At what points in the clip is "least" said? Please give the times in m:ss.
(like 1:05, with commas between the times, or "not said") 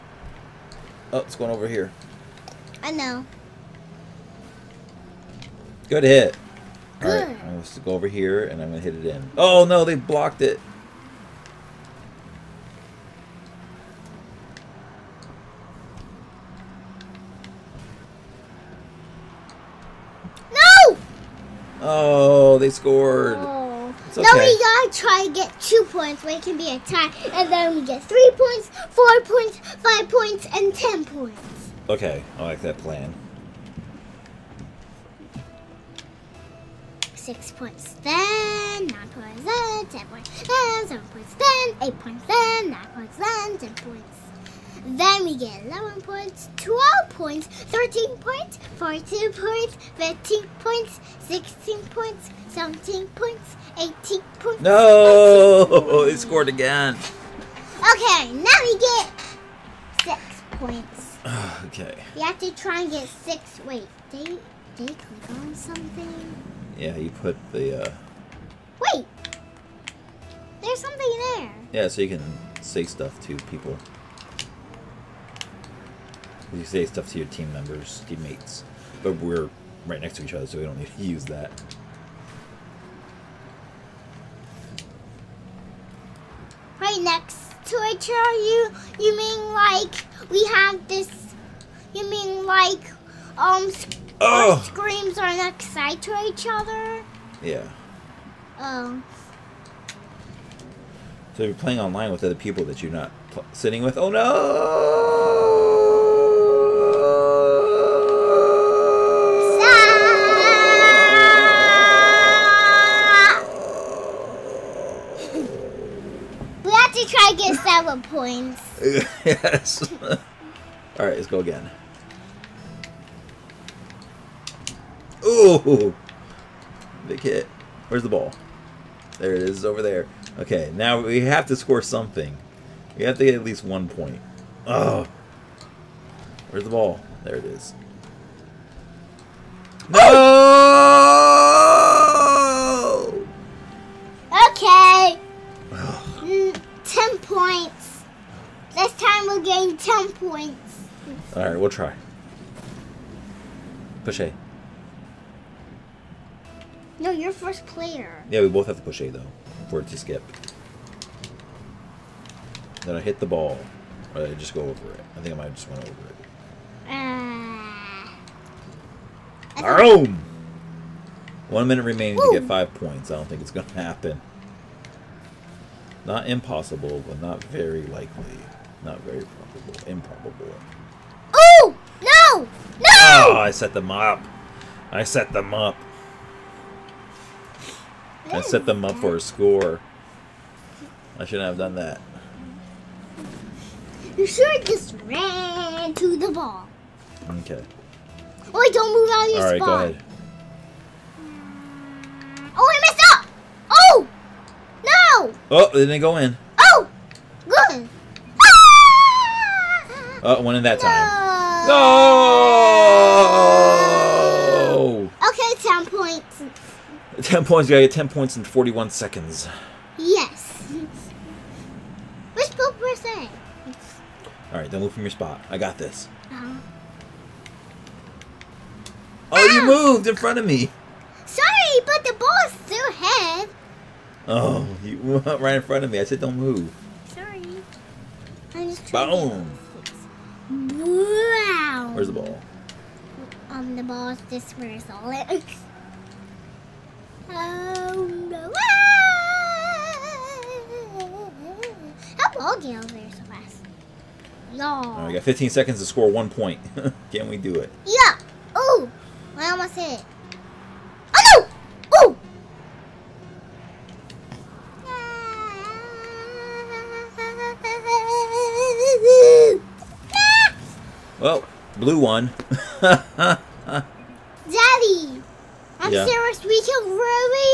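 2:13.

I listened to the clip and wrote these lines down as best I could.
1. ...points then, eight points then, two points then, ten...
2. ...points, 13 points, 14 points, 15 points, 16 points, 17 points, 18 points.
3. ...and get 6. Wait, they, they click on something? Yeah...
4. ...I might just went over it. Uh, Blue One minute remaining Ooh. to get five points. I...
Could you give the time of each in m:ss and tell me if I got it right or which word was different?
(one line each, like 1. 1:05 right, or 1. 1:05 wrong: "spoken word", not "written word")
1. 0:41 wrong: "nine", not "two"
2. 0:47 right
3. 1:02 right
4. 2:45 wrong: "Our", not "Blue".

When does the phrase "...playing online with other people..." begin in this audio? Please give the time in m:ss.
1:41.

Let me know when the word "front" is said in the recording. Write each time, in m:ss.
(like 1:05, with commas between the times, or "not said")
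3:50, 3:55.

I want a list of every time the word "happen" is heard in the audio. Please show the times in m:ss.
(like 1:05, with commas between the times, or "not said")
2:53.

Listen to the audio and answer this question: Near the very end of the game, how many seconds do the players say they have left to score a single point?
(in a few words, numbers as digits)
15.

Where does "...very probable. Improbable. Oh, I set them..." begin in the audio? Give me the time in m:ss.
2:59.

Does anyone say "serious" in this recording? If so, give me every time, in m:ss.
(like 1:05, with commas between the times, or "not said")
4:36.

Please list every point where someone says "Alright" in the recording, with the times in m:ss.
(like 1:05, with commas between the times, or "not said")
0:07, 2:31, 3:44.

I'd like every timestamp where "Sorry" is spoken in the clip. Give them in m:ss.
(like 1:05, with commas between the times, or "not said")
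3:51, 3:57.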